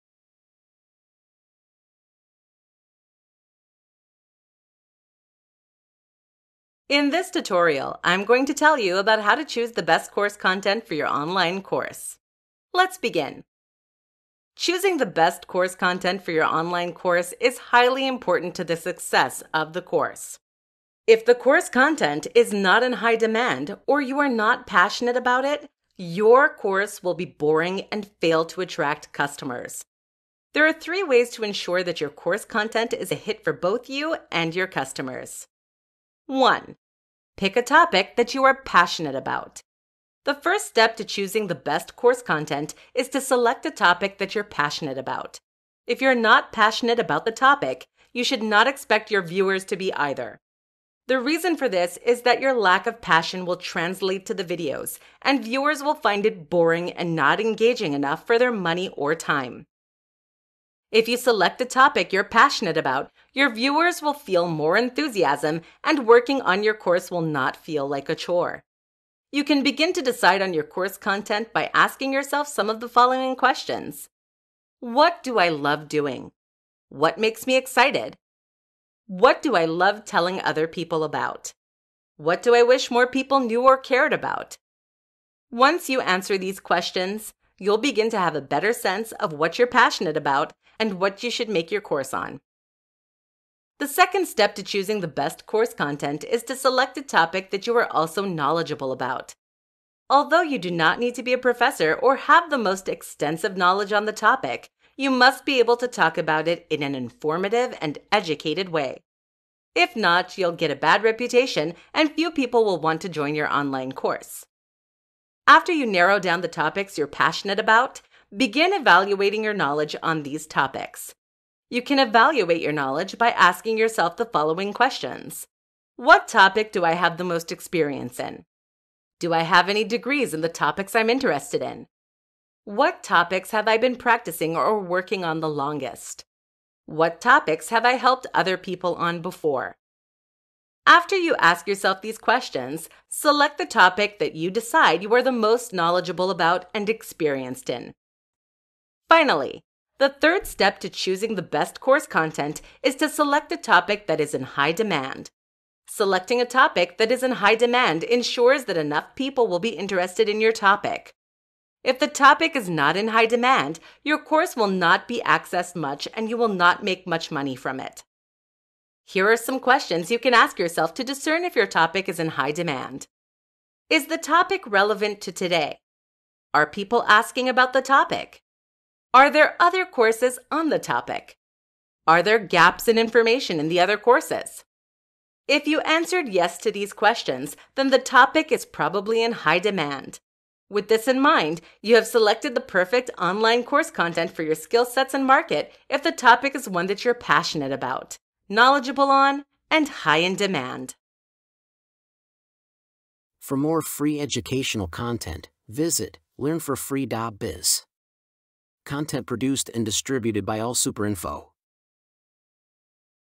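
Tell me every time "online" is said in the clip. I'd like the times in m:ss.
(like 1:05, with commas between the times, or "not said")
0:11, 0:16, 1:53, 3:13.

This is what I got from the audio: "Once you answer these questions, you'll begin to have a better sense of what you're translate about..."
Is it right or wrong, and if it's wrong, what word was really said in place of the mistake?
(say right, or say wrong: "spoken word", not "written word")
wrong: "passionate", not "translate".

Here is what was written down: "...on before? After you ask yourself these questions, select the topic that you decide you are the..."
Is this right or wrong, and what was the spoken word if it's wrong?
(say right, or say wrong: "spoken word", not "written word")
right.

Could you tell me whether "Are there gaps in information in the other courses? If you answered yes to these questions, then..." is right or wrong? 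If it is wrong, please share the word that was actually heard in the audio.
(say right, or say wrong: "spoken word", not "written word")
right.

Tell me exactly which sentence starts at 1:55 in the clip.
After you narrow down the topics you're passionate about, begin evaluating your knowledge on these topics.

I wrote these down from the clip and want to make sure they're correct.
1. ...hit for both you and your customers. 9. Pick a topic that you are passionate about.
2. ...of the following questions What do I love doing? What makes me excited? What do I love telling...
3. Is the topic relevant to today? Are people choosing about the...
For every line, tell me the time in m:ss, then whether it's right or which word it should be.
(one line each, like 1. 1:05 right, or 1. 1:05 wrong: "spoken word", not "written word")
1. 0:33 wrong: "1", not "9"
2. 1:12 right
3. 2:53 wrong: "asking", not "choosing".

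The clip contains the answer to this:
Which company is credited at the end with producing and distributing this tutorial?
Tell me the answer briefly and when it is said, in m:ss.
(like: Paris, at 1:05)
AllSuperInfo, at 3:30.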